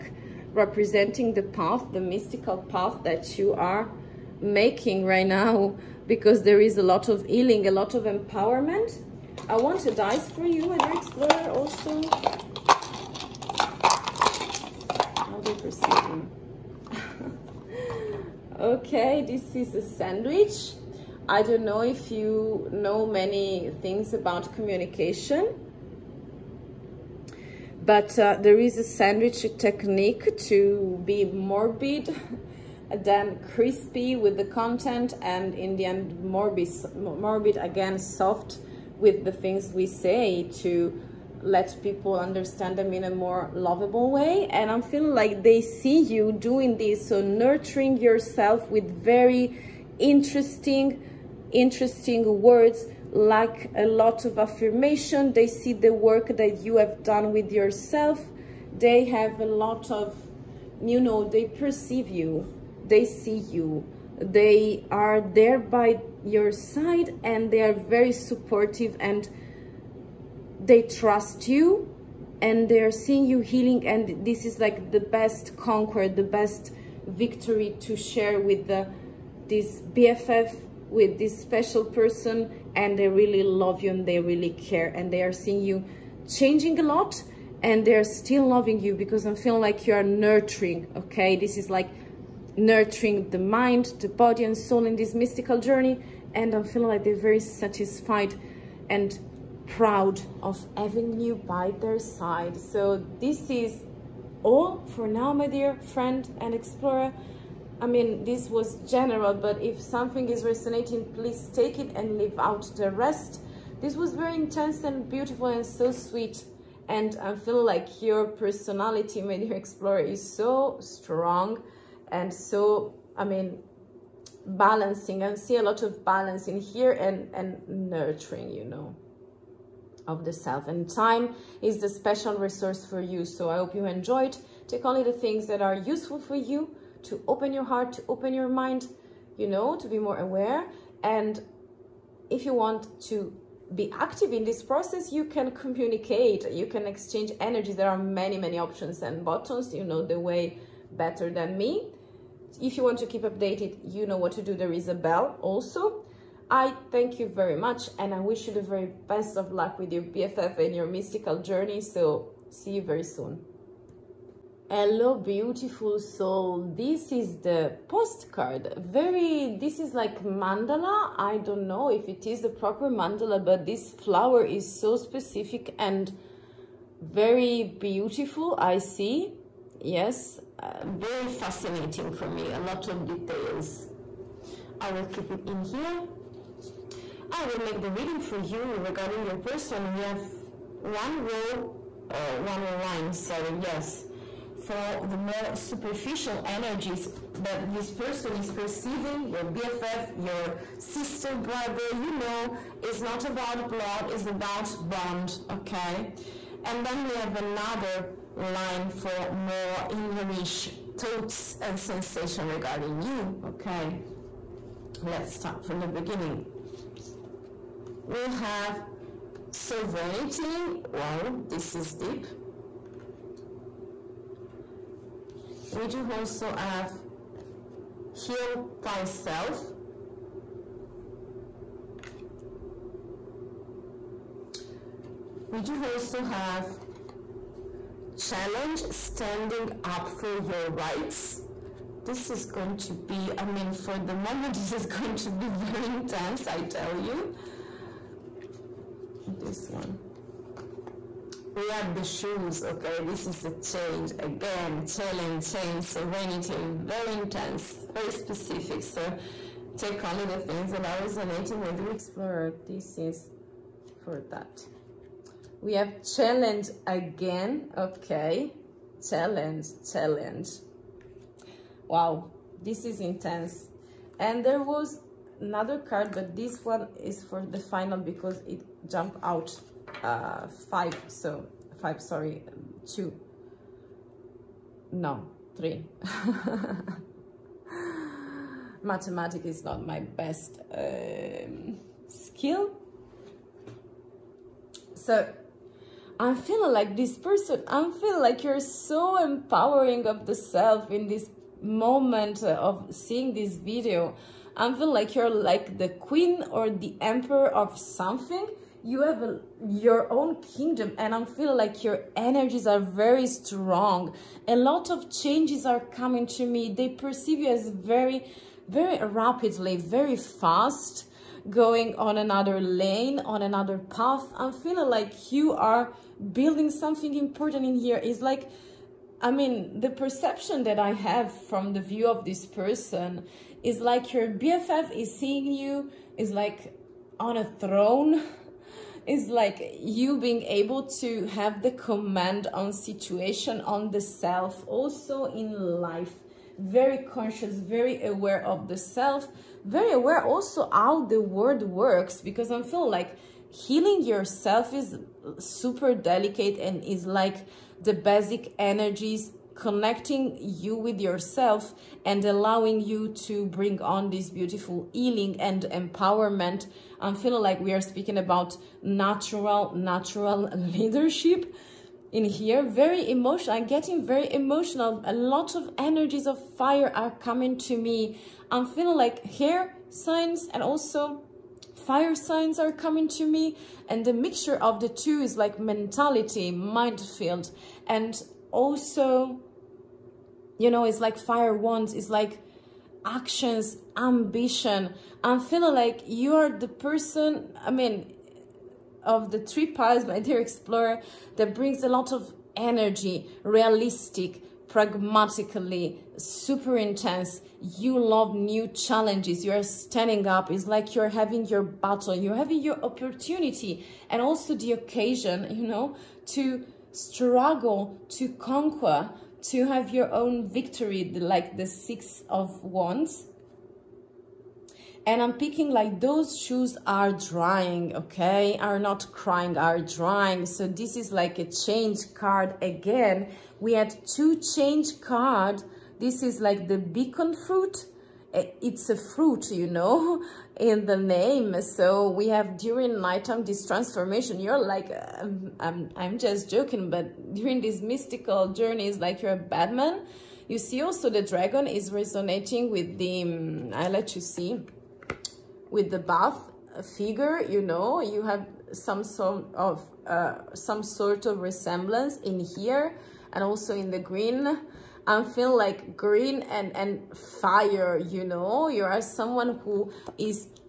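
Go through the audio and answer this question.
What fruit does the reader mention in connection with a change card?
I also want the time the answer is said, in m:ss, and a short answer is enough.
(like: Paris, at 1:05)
beacon fruit, at 7:16.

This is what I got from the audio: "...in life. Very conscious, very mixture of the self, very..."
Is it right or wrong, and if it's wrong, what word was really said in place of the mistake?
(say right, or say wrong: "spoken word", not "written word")
wrong: "aware", not "mixture".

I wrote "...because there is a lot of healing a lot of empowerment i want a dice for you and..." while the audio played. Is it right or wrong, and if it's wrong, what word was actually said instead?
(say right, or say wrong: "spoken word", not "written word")
right.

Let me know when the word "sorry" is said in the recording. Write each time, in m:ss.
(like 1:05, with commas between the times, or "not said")
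3:13, 4:42.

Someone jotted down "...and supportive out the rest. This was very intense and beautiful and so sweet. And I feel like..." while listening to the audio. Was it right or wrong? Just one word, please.
wrong.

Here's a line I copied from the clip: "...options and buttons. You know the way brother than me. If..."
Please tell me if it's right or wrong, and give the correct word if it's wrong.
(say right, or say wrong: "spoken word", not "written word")
wrong: "better", not "brother".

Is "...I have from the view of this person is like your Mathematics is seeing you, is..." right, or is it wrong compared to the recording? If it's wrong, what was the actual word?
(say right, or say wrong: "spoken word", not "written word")
wrong: "BFF", not "Mathematics".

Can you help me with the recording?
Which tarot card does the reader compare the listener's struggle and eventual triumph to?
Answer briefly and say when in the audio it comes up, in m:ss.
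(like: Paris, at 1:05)
Six of Wands, at 7:01.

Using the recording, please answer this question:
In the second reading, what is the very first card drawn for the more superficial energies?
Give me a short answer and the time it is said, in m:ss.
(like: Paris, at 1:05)
Sovereignty, at 3:39.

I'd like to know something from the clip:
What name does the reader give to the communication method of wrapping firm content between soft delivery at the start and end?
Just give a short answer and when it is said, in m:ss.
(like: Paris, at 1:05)
sandwich technique, at 0:28.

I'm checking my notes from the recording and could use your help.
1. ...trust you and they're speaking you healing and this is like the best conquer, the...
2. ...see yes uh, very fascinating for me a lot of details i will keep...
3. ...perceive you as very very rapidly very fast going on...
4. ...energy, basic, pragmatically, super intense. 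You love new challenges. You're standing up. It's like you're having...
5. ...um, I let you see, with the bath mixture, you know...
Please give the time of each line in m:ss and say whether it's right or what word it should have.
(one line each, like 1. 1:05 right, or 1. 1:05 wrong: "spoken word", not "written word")
1. 1:10 wrong: "seeing", not "speaking"
2. 2:58 right
3. 5:16 right
4. 6:42 wrong: "realistic", not "basic"
5. 7:33 wrong: "figure", not "mixture".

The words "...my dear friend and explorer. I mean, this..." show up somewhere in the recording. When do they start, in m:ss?
1:45.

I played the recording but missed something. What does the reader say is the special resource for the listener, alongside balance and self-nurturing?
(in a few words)
time.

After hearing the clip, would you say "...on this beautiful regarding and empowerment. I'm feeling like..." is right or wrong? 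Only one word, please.
wrong.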